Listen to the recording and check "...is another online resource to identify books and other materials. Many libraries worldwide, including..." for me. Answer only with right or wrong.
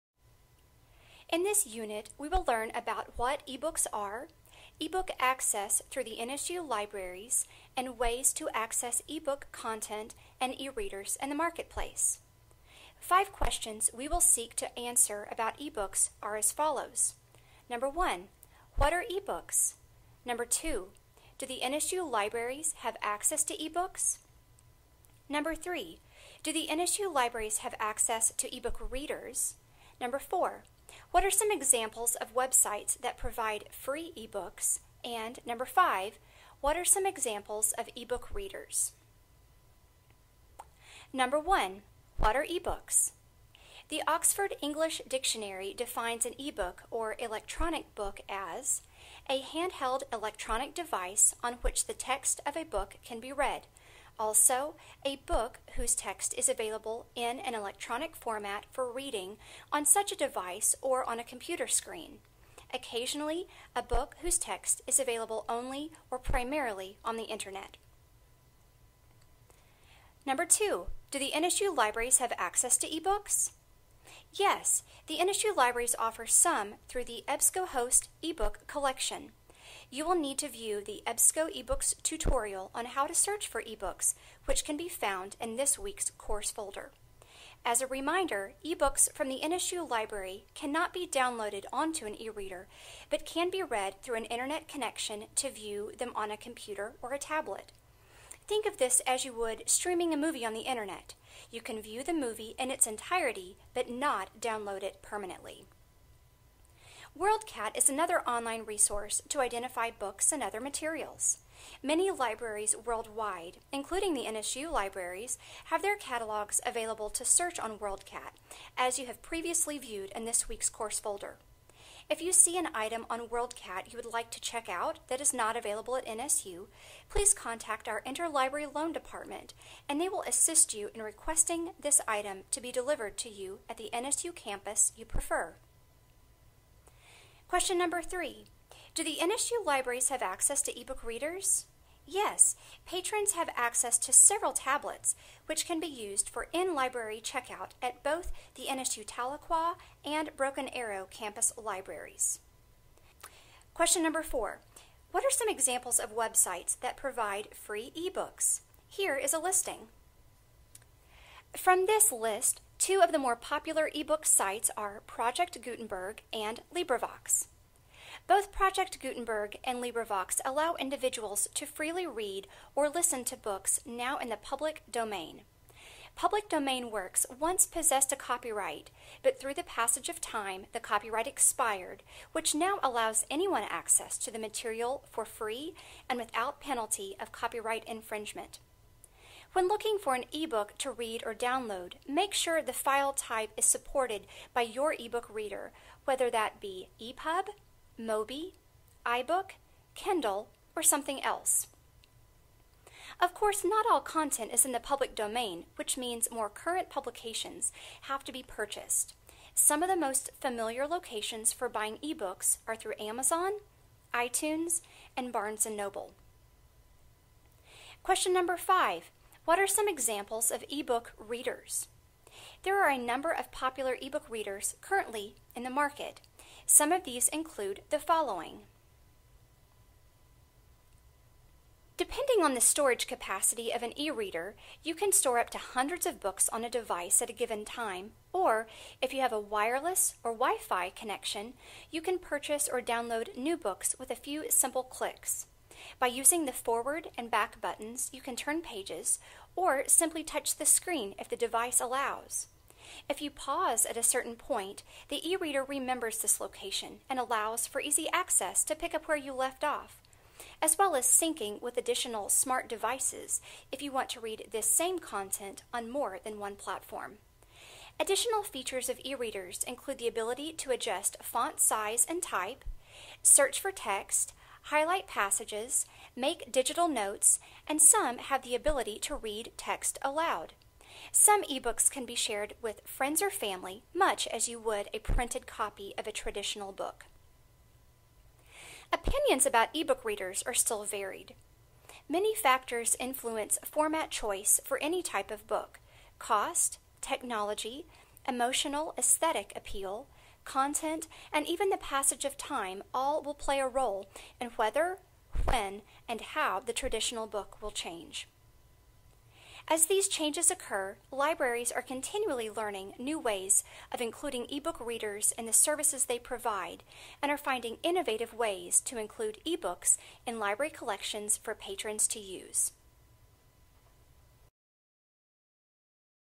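right.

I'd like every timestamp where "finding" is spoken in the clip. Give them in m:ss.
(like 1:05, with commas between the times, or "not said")
5:17.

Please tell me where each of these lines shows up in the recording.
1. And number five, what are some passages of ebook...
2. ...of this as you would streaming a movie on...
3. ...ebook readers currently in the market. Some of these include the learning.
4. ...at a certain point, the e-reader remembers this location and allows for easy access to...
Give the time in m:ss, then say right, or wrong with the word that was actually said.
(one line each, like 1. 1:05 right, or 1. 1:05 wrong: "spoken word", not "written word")
1. 0:35 wrong: "examples", not "passages"
2. 1:38 right
3. 3:43 wrong: "following", not "learning"
4. 4:13 right.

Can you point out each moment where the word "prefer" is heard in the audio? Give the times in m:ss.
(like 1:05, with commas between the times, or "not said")
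2:15.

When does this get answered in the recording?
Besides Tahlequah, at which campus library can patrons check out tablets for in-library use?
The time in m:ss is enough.
2:30.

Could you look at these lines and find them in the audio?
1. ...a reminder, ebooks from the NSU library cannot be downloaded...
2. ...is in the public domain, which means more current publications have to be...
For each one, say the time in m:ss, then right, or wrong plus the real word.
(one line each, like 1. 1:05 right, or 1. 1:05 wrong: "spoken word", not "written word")
1. 1:27 right
2. 3:24 right.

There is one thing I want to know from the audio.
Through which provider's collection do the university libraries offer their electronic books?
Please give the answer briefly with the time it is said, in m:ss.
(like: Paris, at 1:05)
EBSCOhost, at 1:17.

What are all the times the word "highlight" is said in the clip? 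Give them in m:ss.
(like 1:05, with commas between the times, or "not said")
4:34.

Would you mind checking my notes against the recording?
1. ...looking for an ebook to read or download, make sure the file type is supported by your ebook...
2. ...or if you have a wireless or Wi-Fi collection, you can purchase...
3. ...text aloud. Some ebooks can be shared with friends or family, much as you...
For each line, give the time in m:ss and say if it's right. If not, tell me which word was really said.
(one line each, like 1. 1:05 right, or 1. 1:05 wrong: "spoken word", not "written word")
1. 3:09 right
2. 3:58 wrong: "connection", not "collection"
3. 4:39 right.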